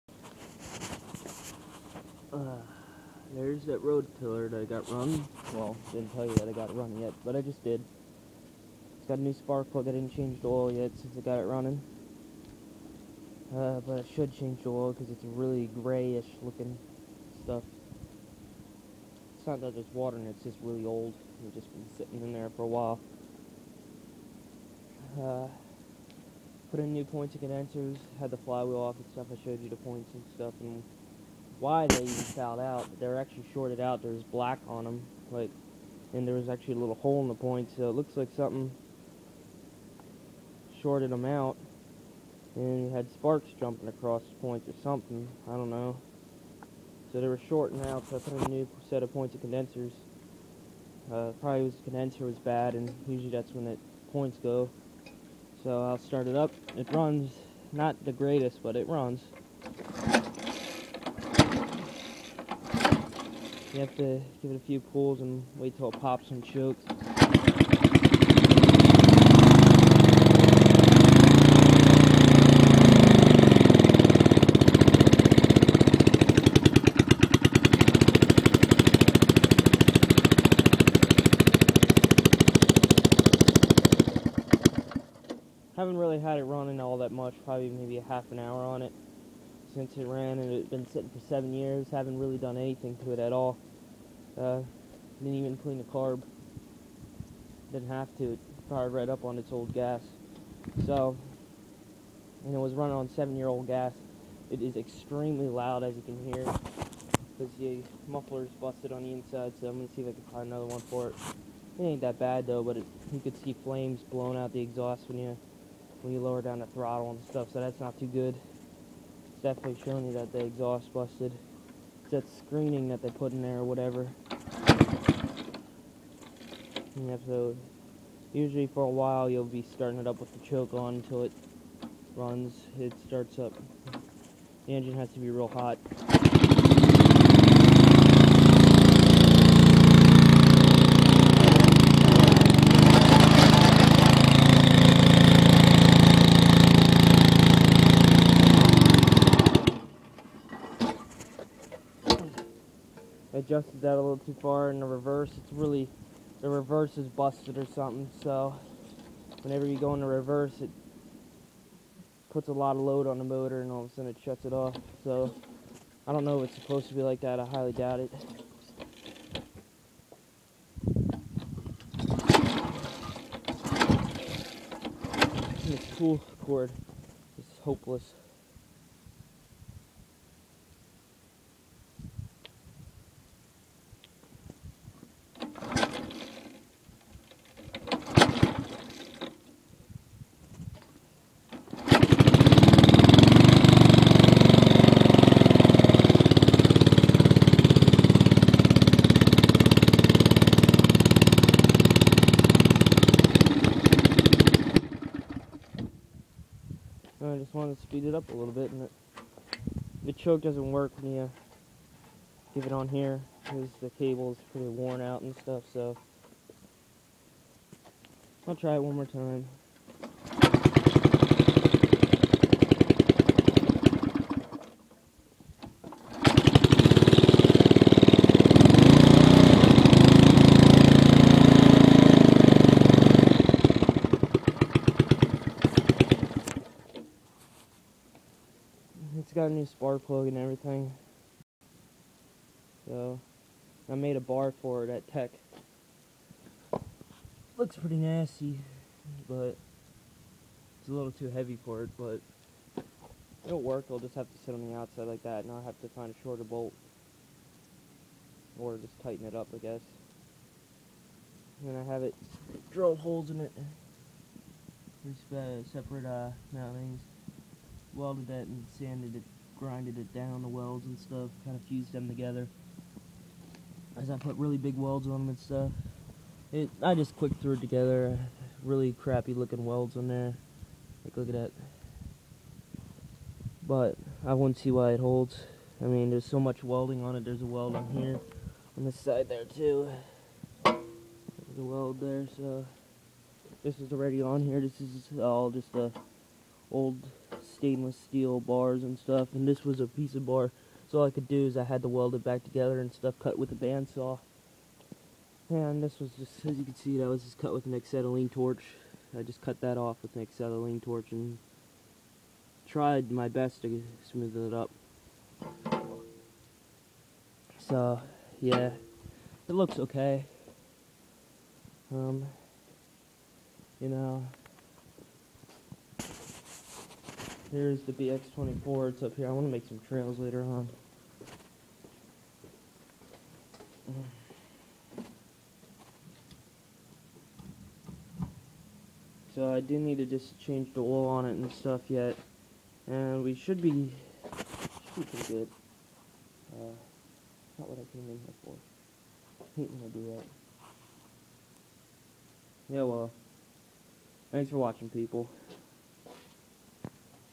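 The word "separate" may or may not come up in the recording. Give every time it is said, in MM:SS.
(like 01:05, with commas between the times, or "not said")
04:25.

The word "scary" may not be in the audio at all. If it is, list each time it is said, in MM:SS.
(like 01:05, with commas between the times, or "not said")
not said.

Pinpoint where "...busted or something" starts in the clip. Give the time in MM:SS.
02:37.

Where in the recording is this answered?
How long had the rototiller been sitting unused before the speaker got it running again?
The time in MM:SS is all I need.
01:31.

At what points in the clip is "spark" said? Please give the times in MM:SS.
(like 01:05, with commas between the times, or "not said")
00:09, 00:43, 03:59.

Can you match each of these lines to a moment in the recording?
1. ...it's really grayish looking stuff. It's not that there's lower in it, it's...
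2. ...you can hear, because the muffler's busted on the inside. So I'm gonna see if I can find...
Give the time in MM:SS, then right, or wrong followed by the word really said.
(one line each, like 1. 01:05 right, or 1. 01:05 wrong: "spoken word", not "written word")
1. 00:15 wrong: "water", not "lower"
2. 01:45 right.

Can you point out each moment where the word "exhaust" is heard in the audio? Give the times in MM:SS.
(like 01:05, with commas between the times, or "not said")
01:54, 02:00.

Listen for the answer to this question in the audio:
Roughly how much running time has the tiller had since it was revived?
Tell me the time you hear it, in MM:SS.
01:28.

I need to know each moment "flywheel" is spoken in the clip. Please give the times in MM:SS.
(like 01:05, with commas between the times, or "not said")
00:28.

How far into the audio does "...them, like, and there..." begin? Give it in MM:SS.
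00:34.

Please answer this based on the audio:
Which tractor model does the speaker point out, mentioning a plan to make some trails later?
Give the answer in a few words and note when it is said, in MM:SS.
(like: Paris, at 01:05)
BX24, at 05:27.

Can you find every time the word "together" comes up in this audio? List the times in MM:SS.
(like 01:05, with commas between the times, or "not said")
04:32, 04:37, 05:02.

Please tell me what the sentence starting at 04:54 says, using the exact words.
This is all just a old stainless steel bars and stuff, and this was a piece of bar.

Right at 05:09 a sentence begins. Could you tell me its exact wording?
I just cut that off with an acetylene torch and tried my best to smooth it up.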